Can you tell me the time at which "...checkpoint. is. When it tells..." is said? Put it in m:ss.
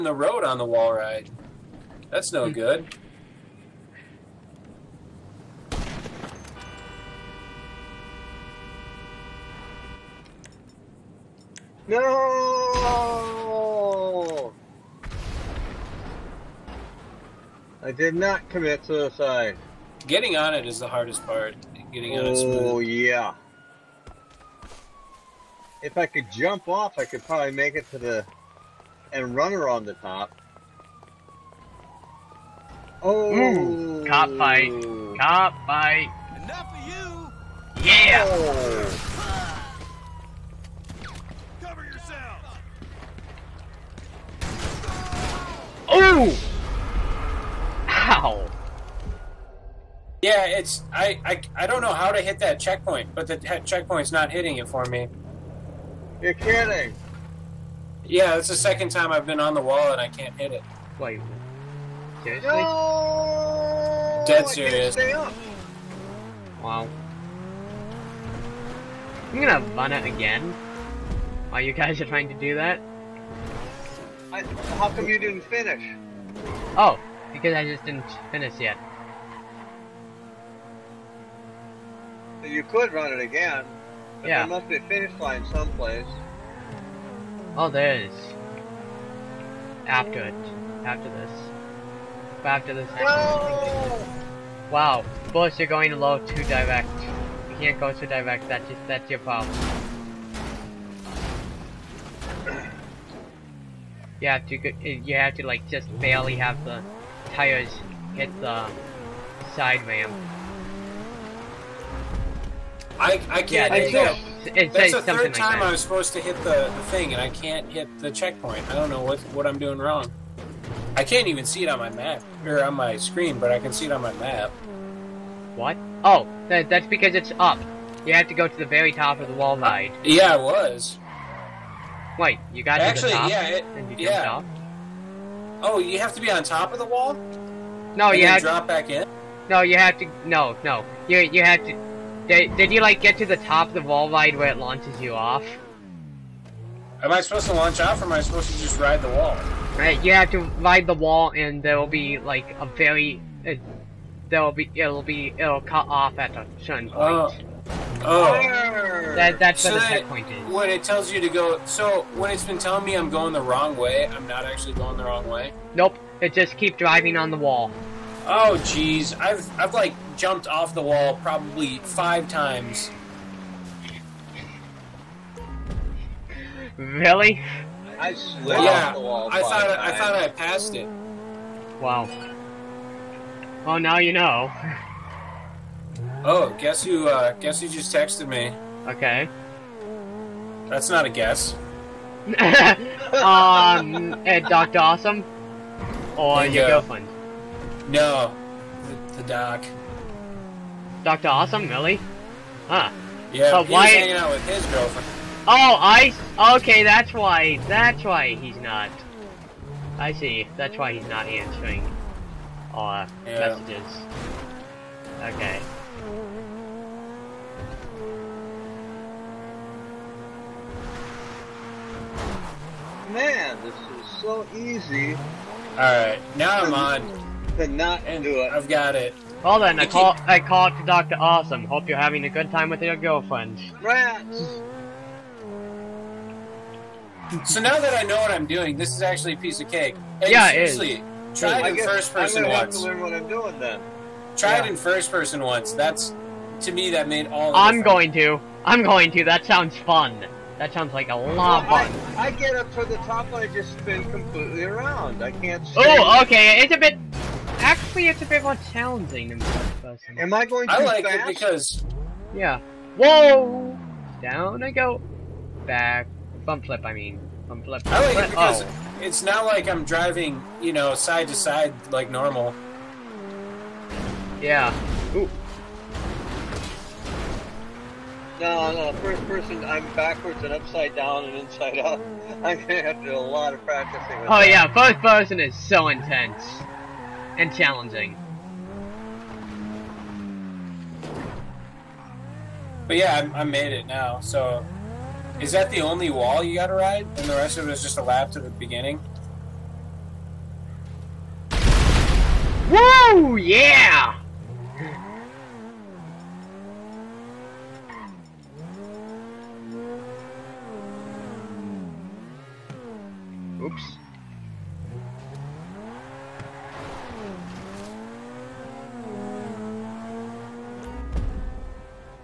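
2:39.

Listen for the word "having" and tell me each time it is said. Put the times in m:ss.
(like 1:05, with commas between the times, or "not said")
3:51.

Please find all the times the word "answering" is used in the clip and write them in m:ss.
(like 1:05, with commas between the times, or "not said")
3:31.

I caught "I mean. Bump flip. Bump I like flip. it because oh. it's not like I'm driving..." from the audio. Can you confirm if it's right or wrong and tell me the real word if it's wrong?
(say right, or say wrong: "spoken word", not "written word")
right.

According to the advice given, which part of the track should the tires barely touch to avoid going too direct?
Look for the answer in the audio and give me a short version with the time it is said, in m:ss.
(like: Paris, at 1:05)
side ramp, at 1:49.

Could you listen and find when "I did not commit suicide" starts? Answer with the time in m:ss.
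0:17.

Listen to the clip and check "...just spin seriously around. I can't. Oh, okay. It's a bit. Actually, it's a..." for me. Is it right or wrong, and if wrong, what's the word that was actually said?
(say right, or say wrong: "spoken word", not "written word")
wrong: "completely", not "seriously".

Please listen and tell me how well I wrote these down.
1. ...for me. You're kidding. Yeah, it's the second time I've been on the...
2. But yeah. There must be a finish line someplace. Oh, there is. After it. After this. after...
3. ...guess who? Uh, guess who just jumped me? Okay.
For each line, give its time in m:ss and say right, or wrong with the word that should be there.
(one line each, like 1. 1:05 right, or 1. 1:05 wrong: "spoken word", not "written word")
1. 0:54 right
2. 1:24 right
3. 3:06 wrong: "texted", not "jumped".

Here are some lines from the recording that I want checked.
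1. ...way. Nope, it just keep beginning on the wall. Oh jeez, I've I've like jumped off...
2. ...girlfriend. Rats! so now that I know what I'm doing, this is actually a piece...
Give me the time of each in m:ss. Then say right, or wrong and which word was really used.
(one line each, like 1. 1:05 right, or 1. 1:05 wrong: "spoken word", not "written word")
1. 2:45 wrong: "driving", not "beginning"
2. 3:52 right.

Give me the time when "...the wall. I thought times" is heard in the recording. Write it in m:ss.
2:58.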